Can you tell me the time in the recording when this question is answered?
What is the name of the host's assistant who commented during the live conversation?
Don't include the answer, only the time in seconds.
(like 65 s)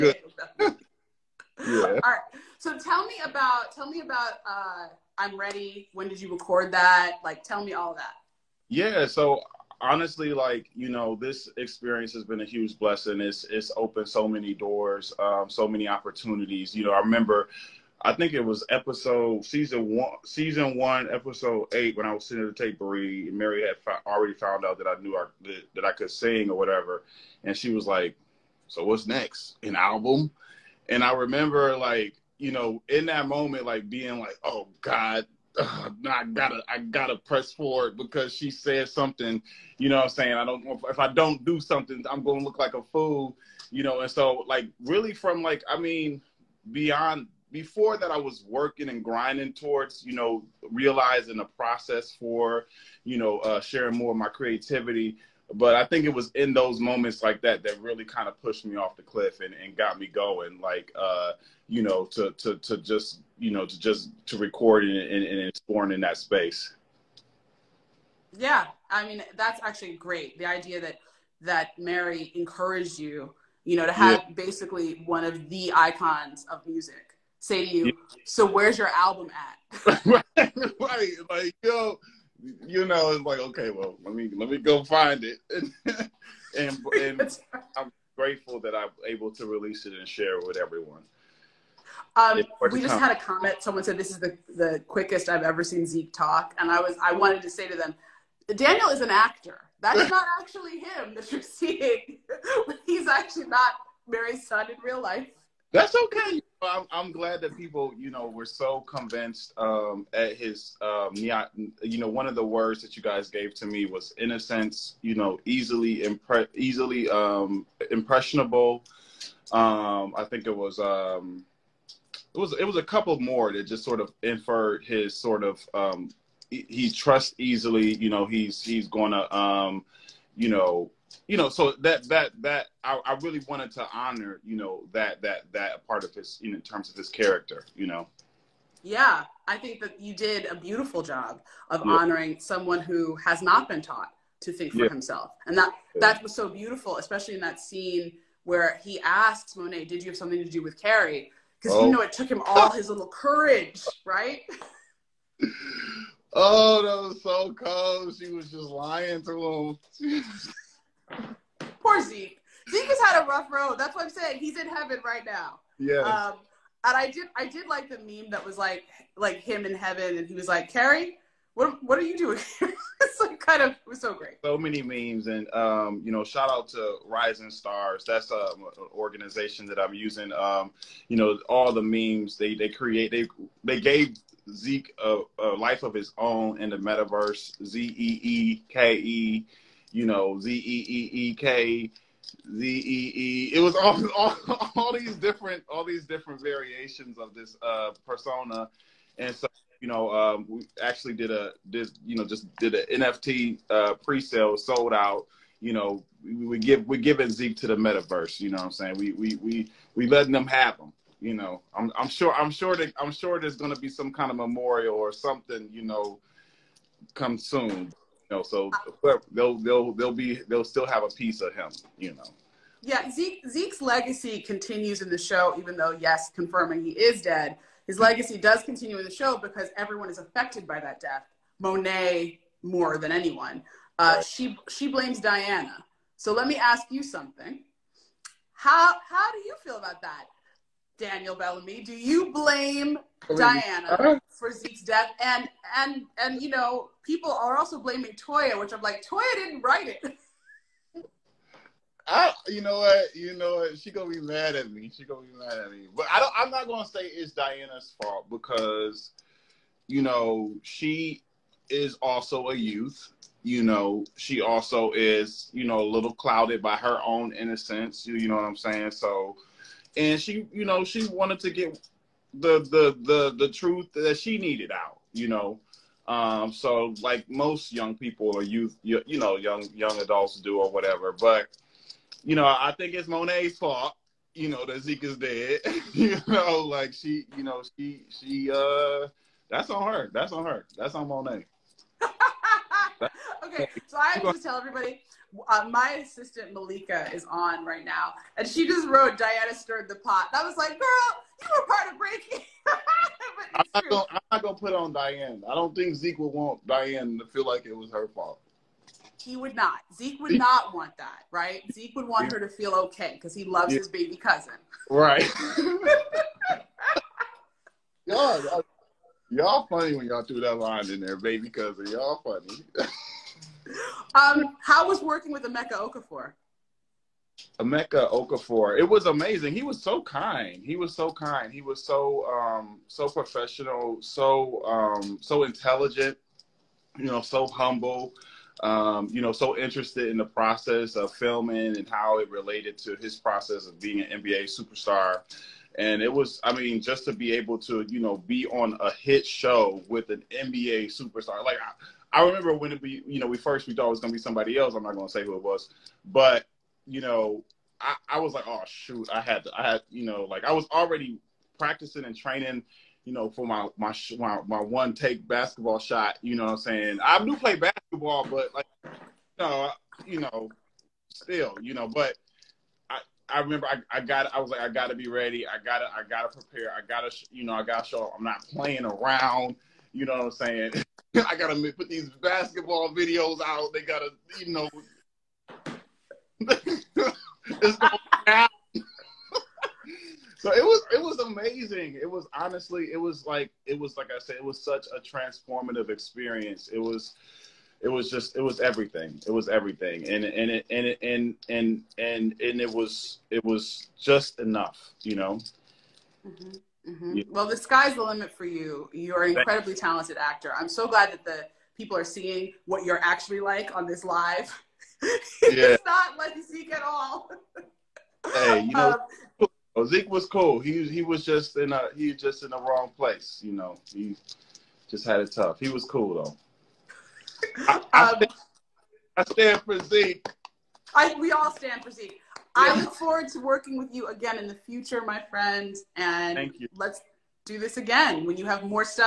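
296 s.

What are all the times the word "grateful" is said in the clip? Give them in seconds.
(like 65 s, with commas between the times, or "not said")
88 s.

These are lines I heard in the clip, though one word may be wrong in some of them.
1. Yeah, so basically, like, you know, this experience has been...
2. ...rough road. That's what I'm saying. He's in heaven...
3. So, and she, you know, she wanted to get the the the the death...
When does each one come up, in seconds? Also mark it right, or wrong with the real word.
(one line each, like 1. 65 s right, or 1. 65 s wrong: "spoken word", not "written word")
1. 8 s wrong: "honestly", not "basically"
2. 163 s right
3. 268 s wrong: "truth", not "death".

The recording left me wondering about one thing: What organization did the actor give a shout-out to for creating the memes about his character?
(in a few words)
Rising Stars.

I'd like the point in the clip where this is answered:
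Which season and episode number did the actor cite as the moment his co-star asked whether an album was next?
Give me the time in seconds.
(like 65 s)
20 s.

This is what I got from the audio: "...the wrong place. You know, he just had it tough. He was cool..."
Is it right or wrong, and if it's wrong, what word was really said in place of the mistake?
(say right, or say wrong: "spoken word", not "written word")
right.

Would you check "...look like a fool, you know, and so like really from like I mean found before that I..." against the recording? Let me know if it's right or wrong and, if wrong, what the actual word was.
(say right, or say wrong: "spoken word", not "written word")
wrong: "beyond", not "found".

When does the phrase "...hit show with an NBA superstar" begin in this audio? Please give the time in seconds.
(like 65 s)
348 s.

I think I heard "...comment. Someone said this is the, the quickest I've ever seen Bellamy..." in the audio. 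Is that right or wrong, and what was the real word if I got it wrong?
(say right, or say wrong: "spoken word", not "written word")
wrong: "Zeke", not "Bellamy".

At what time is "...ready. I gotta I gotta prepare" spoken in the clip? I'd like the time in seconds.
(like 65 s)
375 s.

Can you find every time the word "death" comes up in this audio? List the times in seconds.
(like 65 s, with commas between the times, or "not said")
230 s, 244 s.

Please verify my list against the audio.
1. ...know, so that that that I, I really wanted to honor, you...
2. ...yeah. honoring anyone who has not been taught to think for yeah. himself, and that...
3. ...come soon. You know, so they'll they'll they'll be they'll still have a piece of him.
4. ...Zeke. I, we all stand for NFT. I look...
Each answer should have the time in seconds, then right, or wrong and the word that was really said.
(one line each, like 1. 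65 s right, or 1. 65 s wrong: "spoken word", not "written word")
1. 131 s right
2. 141 s wrong: "someone", not "anyone"
3. 217 s right
4. 429 s wrong: "Zeke", not "NFT".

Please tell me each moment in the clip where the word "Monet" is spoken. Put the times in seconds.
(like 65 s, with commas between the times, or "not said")
149 s, 231 s, 283 s, 291 s.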